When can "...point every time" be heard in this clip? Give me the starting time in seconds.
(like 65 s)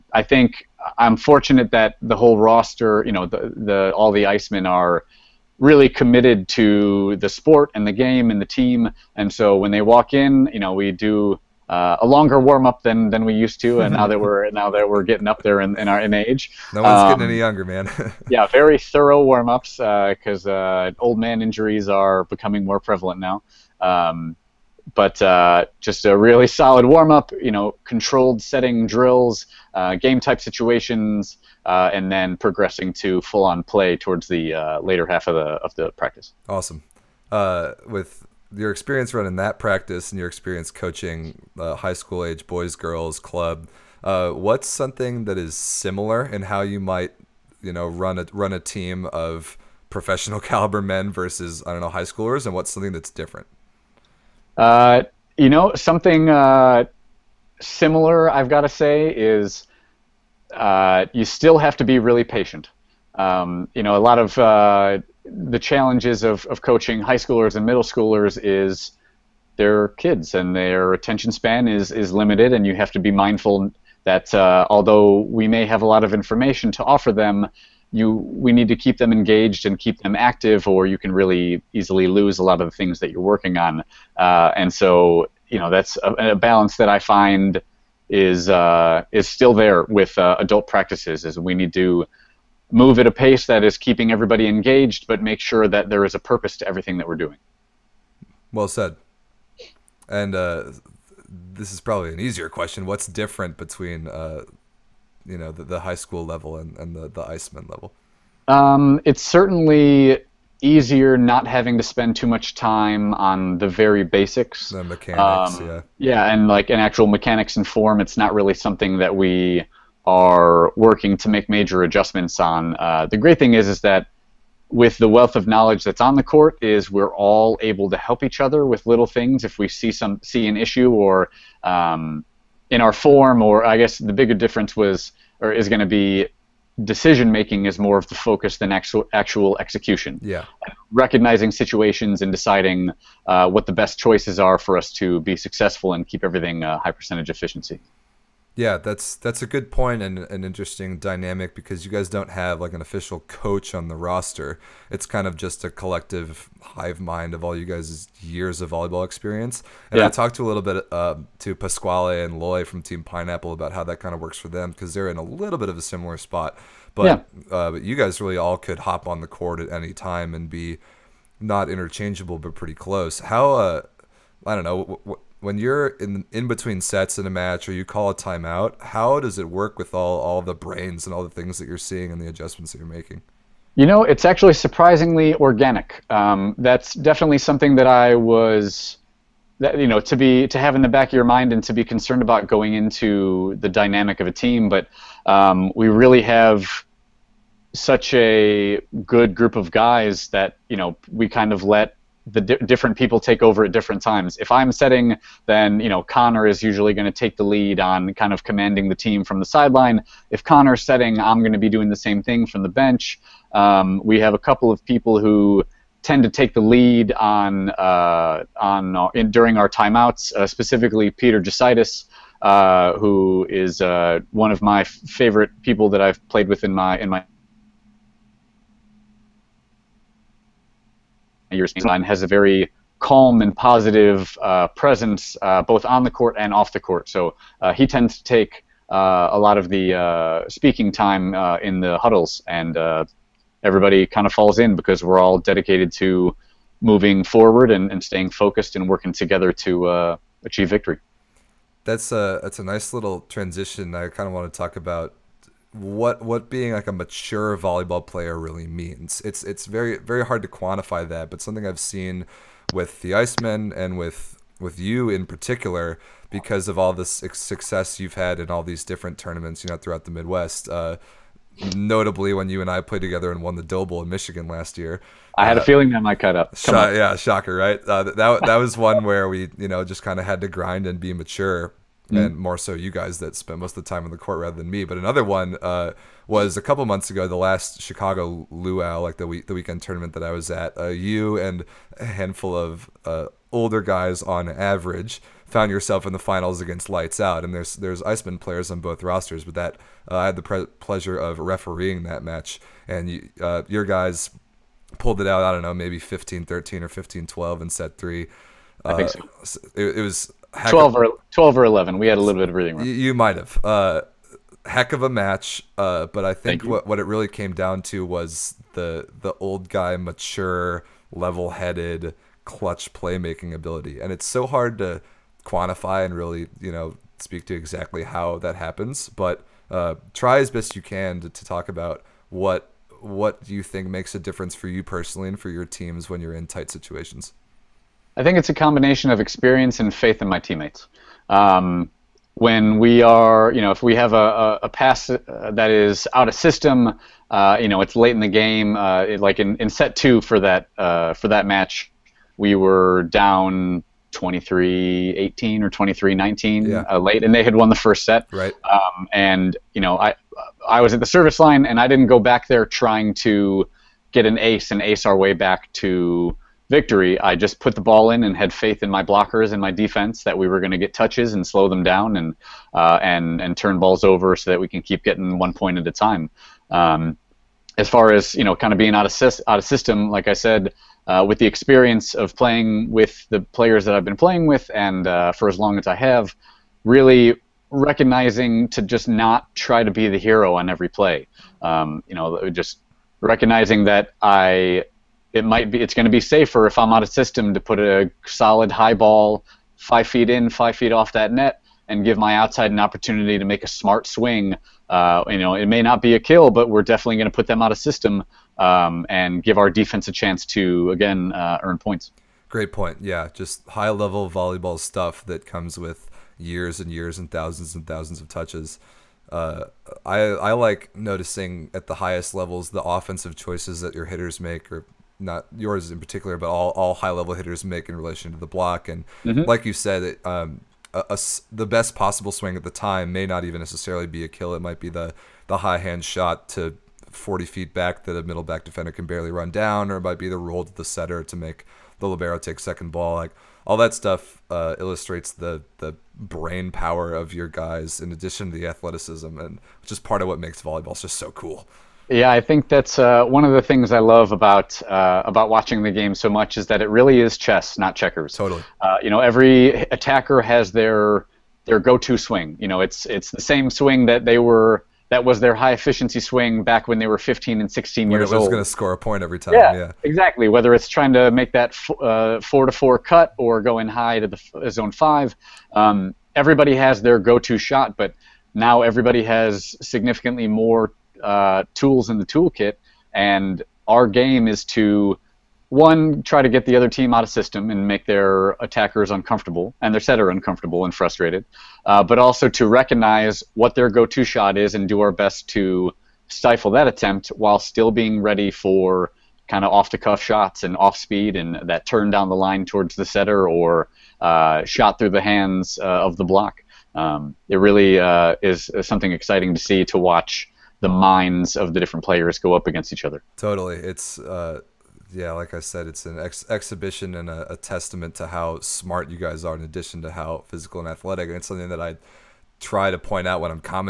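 468 s.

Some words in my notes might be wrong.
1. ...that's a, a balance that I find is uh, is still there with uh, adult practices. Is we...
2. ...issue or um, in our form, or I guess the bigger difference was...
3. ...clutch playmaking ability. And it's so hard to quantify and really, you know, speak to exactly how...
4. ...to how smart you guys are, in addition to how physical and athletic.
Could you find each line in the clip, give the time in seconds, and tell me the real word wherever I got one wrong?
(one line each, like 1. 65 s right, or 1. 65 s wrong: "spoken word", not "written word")
1. 85 s right
2. 130 s right
3. 322 s right
4. 518 s right.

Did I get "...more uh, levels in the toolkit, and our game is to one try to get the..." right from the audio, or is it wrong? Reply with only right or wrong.
wrong.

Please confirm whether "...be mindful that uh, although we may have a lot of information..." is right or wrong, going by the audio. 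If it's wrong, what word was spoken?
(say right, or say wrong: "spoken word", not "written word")
right.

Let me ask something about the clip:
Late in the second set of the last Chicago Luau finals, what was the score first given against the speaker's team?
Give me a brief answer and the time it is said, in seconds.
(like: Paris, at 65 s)
23-18, at 354 s.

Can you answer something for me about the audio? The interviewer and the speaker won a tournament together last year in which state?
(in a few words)
Michigan.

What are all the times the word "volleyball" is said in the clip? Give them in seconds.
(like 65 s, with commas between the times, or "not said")
158 s, 257 s, 414 s, 450 s.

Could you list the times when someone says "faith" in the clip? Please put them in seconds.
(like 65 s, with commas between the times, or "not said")
339 s, 368 s.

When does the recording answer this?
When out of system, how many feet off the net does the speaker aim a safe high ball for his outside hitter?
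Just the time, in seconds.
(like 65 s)
400 s.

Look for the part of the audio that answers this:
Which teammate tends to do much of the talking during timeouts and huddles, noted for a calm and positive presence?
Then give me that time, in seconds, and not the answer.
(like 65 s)
221 s.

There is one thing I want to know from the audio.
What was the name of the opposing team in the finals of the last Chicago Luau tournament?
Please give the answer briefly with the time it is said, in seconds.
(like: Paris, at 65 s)
Lights Out, at 296 s.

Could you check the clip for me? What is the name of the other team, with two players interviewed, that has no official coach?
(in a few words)
Team Pineapple.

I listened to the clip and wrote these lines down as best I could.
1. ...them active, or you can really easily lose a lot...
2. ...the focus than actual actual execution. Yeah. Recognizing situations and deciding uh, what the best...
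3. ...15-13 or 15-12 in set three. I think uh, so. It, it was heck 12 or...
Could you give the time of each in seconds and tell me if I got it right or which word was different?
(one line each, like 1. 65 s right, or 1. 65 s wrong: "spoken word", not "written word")
1. 80 s right
2. 138 s right
3. 305 s right.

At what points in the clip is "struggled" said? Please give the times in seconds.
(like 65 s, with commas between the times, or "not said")
not said.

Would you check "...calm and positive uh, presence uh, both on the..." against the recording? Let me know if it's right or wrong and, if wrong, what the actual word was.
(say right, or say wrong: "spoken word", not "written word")
right.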